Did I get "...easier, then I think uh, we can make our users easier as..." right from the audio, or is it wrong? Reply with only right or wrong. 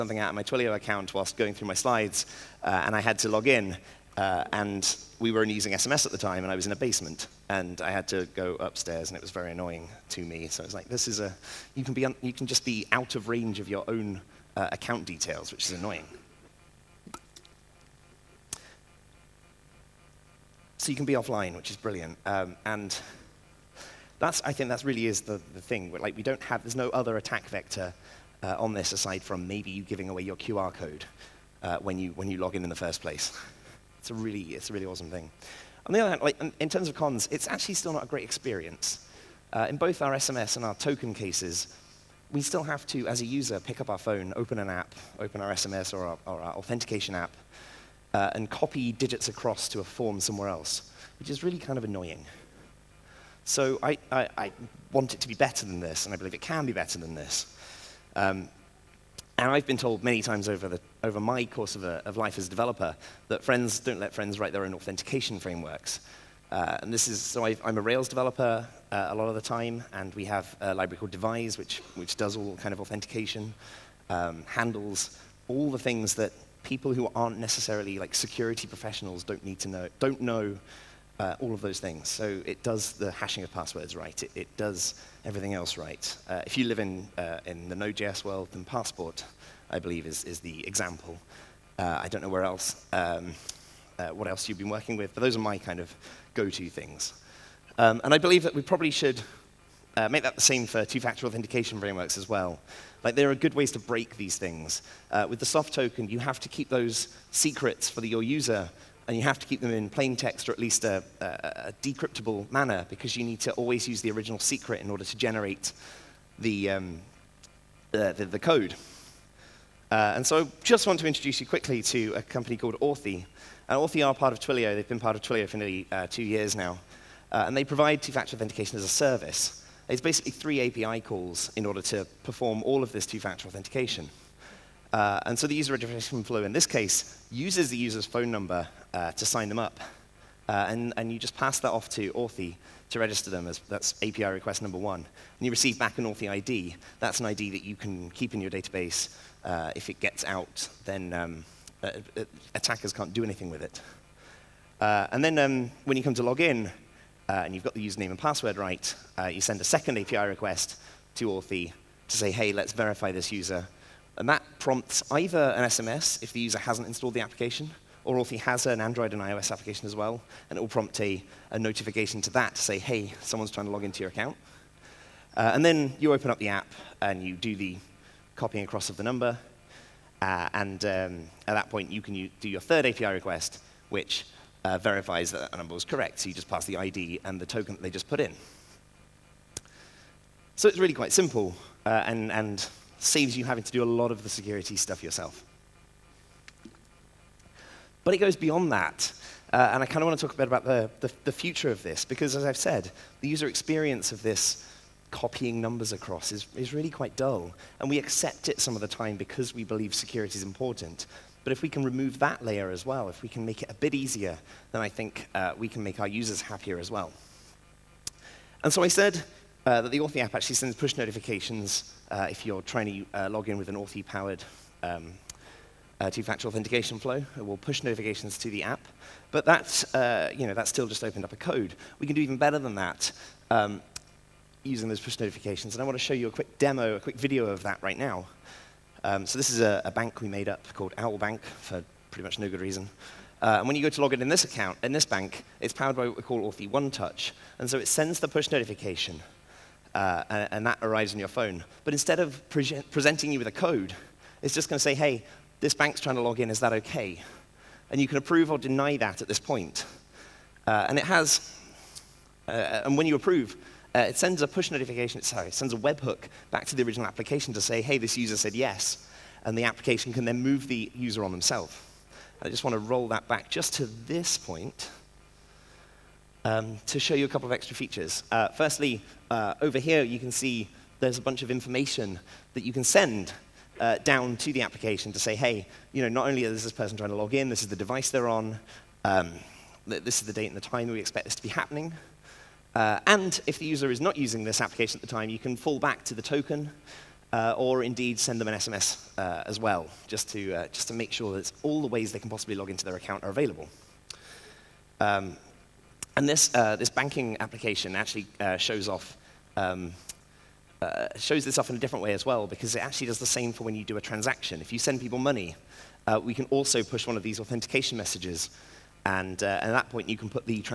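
wrong.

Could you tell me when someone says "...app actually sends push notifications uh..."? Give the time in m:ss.
3:40.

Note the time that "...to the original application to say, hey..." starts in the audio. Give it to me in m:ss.
4:26.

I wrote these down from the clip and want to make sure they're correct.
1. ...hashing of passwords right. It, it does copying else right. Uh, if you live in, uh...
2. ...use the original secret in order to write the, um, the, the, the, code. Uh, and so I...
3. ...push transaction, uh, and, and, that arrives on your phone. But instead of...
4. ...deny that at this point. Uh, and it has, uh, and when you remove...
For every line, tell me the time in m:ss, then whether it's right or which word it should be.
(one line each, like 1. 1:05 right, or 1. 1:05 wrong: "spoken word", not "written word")
1. 1:23 wrong: "everything", not "copying"
2. 1:53 wrong: "generate", not "write"
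3. 4:08 wrong: "notification", not "transaction"
4. 4:18 wrong: "approve", not "remove".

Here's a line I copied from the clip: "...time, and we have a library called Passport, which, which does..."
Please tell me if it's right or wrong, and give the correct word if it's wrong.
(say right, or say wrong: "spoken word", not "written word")
wrong: "Devise", not "Passport".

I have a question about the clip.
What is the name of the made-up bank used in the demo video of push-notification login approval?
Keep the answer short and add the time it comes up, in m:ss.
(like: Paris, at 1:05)
Owl Bank, at 4:00.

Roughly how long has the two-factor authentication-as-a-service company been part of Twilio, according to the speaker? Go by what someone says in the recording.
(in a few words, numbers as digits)
nearly 2 years.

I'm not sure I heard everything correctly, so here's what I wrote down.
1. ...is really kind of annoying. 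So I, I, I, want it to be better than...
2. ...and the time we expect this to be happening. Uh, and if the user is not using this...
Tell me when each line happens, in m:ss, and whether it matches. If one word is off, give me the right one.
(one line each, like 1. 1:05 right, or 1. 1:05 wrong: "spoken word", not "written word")
1. 0:51 right
2. 4:50 right.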